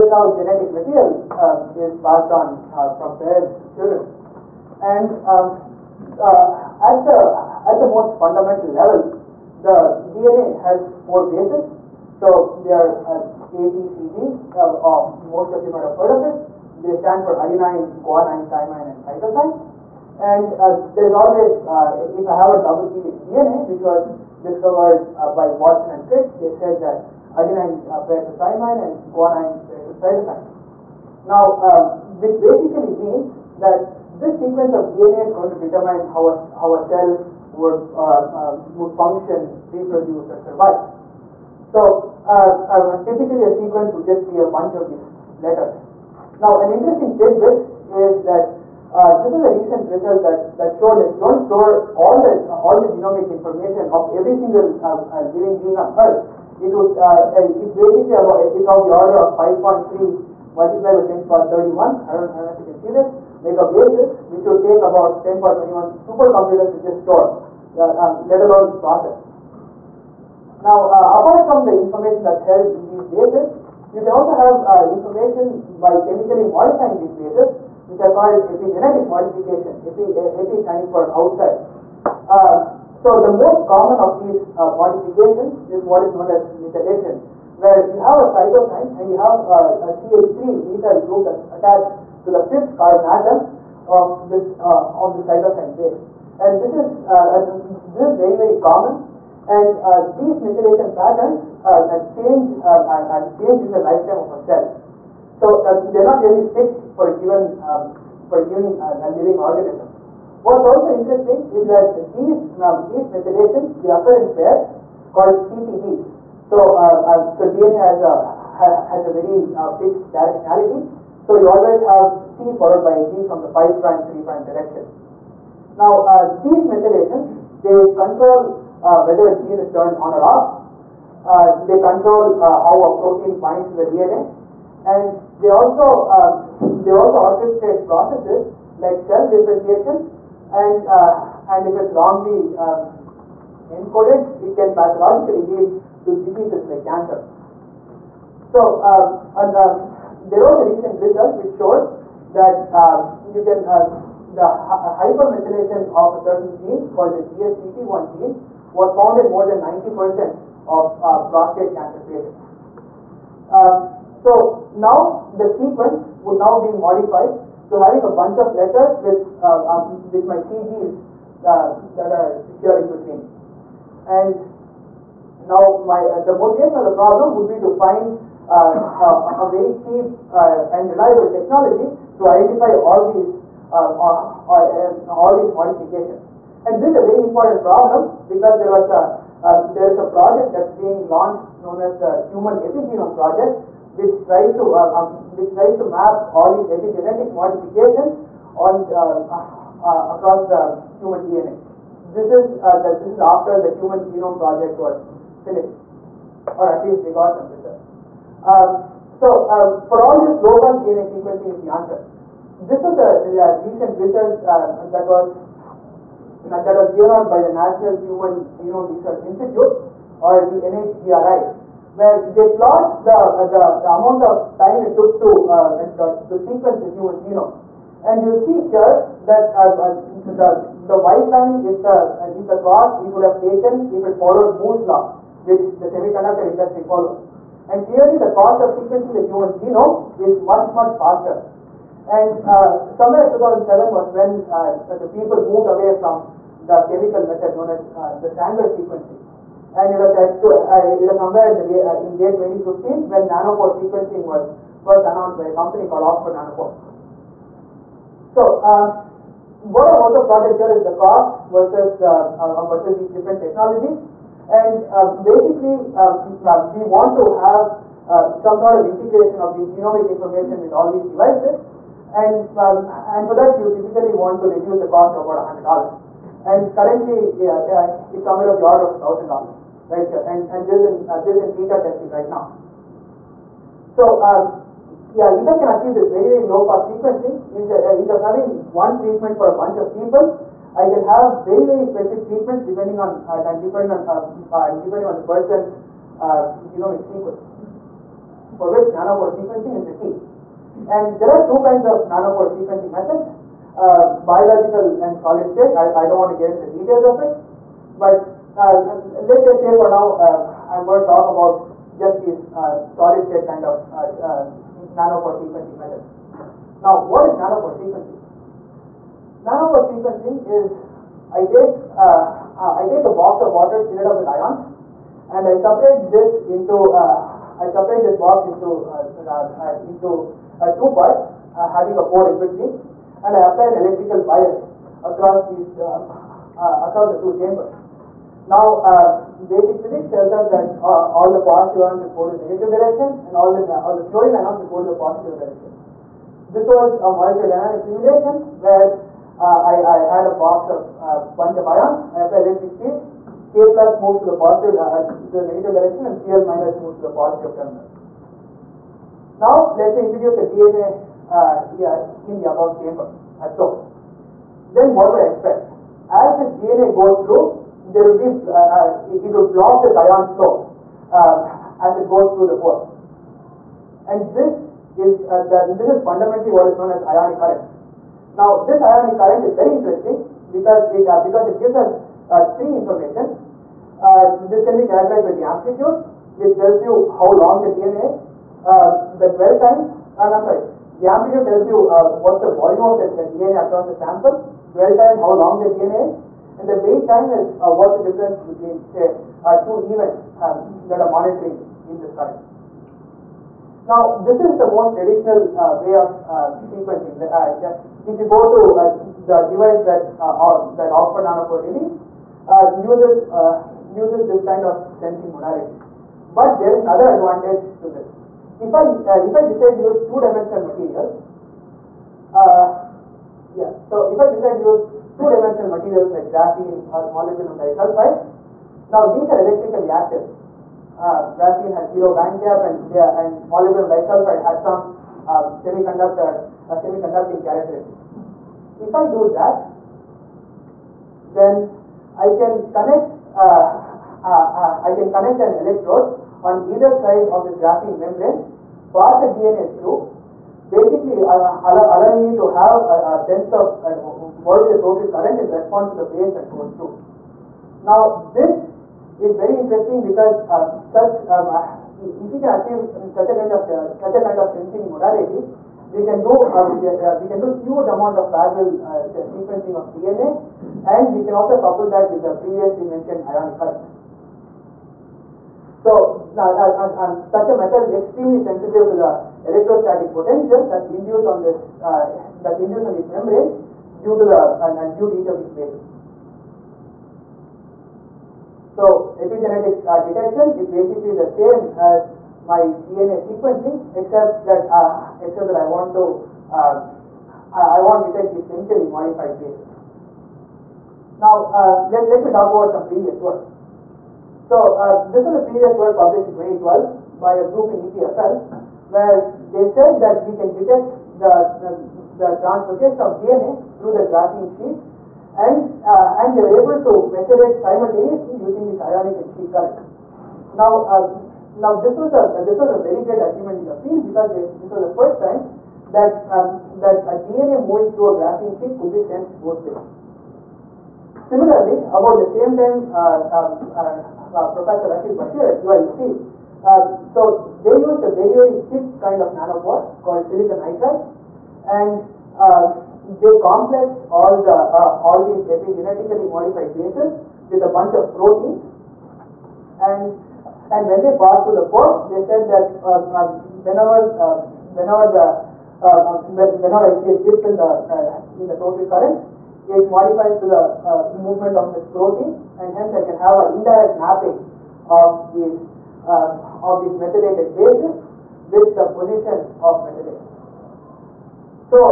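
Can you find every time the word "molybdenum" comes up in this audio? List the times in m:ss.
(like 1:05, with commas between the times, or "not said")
7:07, 7:13.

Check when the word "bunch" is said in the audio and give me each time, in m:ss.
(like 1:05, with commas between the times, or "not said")
0:44, 2:48, 4:49, 5:51, 9:07.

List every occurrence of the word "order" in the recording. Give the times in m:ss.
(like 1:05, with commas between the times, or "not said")
0:58, 4:38.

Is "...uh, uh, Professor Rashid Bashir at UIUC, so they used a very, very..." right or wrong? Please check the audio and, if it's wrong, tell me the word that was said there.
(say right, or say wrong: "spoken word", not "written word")
right.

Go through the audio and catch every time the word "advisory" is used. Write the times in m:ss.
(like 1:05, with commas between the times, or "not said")
not said.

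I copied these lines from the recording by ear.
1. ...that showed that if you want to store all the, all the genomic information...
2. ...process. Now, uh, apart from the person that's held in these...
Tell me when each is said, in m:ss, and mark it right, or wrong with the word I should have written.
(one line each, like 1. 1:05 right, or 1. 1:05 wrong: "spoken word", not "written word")
1. 0:50 right
2. 1:08 wrong: "information", not "person".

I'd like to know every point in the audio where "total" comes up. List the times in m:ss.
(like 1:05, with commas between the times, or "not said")
7:34, 9:18.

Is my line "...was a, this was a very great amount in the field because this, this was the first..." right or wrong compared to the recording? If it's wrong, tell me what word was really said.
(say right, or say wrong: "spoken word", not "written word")
wrong: "achievement", not "amount".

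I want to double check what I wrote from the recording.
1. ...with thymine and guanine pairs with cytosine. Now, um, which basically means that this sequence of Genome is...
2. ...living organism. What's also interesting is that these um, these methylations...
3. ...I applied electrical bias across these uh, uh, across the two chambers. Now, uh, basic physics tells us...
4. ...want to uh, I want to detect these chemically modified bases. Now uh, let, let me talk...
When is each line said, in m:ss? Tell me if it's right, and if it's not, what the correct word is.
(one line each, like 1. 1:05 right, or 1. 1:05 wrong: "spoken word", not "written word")
1. 0:28 wrong: "DNA", not "Genome"
2. 1:49 right
3. 5:33 right
4. 8:15 right.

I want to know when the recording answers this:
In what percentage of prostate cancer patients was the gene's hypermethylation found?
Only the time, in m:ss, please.
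2:39.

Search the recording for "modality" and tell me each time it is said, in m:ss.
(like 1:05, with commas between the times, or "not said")
6:55, 7:44.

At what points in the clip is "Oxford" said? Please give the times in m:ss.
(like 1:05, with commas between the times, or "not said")
4:16, 6:50.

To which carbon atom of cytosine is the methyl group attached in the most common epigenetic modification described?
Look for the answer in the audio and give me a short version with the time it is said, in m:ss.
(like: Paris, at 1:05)
fifth carbon, at 1:32.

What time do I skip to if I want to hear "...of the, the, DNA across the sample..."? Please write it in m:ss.
6:32.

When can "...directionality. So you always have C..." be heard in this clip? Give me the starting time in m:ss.
2:00.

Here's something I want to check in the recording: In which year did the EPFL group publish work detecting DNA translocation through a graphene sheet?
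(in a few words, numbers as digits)
2012.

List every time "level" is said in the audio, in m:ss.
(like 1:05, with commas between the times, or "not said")
0:08.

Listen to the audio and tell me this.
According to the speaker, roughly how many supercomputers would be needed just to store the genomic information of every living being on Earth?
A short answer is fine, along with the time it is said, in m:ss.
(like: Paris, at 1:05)
10^21, at 1:05.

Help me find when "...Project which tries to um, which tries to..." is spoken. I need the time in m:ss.
3:13.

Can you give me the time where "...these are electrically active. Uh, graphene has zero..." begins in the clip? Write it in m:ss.
7:09.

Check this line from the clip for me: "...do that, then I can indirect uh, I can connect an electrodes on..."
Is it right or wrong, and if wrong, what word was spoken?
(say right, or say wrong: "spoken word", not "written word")
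wrong: "connect", not "indirect".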